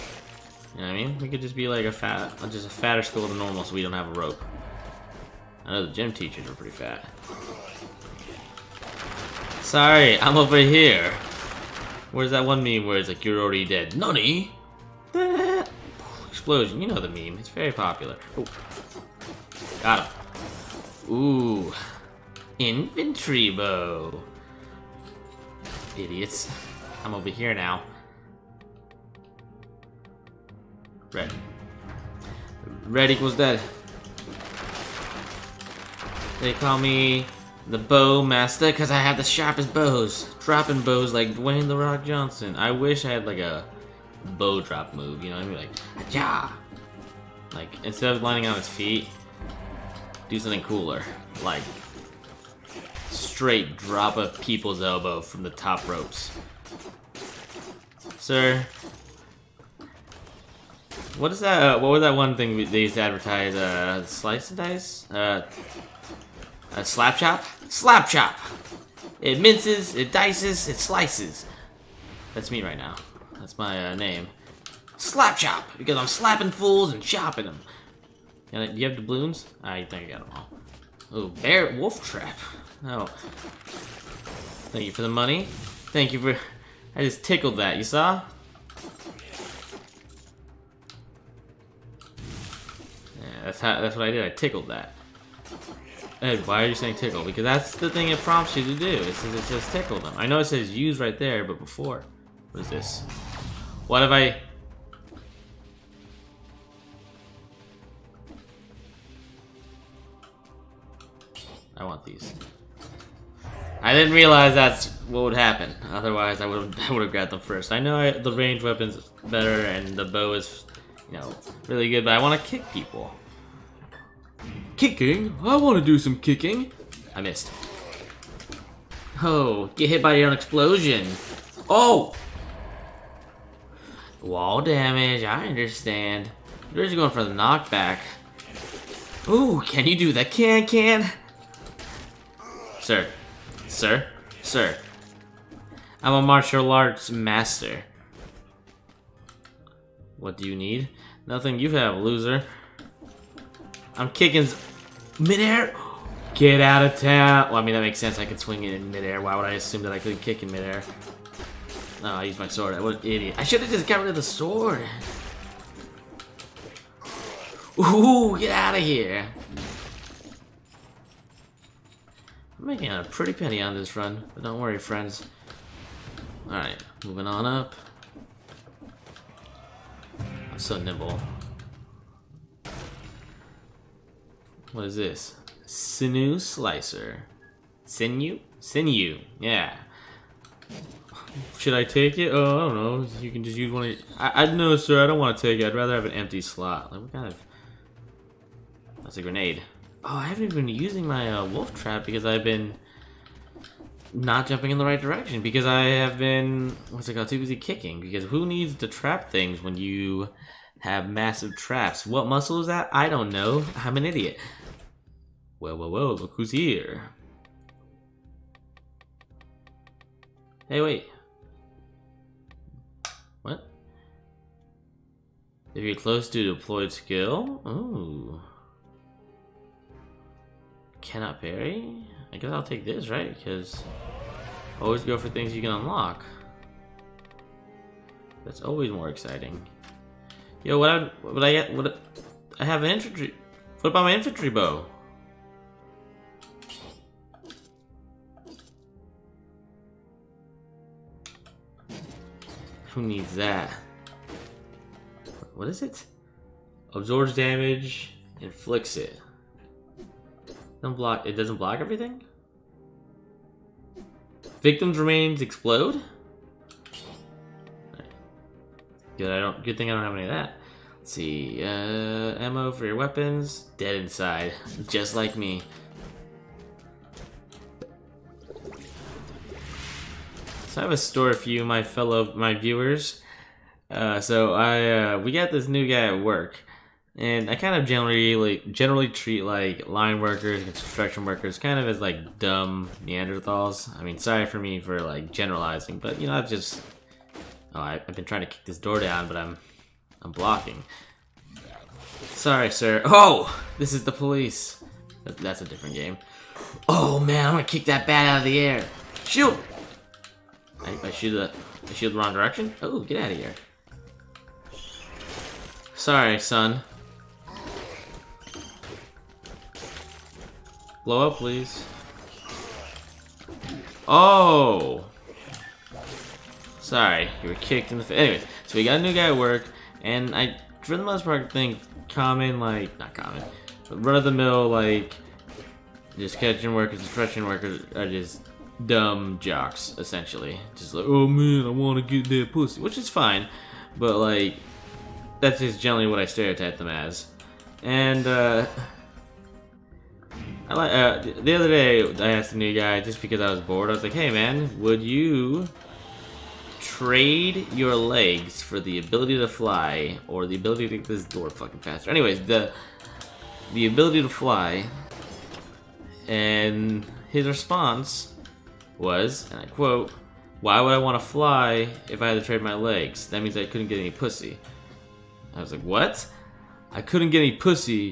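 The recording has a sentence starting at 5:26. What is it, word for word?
Sorry, you were kicked in the face.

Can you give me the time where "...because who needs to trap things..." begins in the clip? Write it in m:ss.
3:27.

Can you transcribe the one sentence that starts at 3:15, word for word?
I'd rather have an empty slot.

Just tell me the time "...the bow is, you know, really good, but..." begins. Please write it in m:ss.
1:59.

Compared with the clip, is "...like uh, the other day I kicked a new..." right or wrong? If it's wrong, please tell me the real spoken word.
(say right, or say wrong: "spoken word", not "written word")
wrong: "asked", not "kicked".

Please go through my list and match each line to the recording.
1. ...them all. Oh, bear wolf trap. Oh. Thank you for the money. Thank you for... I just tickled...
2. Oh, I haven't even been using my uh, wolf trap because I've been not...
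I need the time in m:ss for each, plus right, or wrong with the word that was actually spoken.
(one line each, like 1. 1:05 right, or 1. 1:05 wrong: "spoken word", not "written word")
1. 1:20 right
2. 3:20 right.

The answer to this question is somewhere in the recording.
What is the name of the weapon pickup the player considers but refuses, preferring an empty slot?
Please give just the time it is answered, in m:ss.
3:05.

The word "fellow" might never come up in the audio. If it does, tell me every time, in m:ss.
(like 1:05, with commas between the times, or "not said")
4:41.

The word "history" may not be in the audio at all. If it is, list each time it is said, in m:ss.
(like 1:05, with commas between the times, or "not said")
not said.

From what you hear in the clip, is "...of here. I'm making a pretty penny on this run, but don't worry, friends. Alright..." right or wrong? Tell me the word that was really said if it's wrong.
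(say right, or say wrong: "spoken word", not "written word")
right.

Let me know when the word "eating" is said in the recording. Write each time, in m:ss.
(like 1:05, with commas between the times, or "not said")
not said.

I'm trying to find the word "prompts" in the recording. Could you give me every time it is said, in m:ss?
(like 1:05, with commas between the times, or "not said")
1:38.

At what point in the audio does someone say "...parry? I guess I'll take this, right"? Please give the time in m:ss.
3:51.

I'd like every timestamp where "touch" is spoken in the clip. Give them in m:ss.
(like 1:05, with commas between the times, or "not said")
not said.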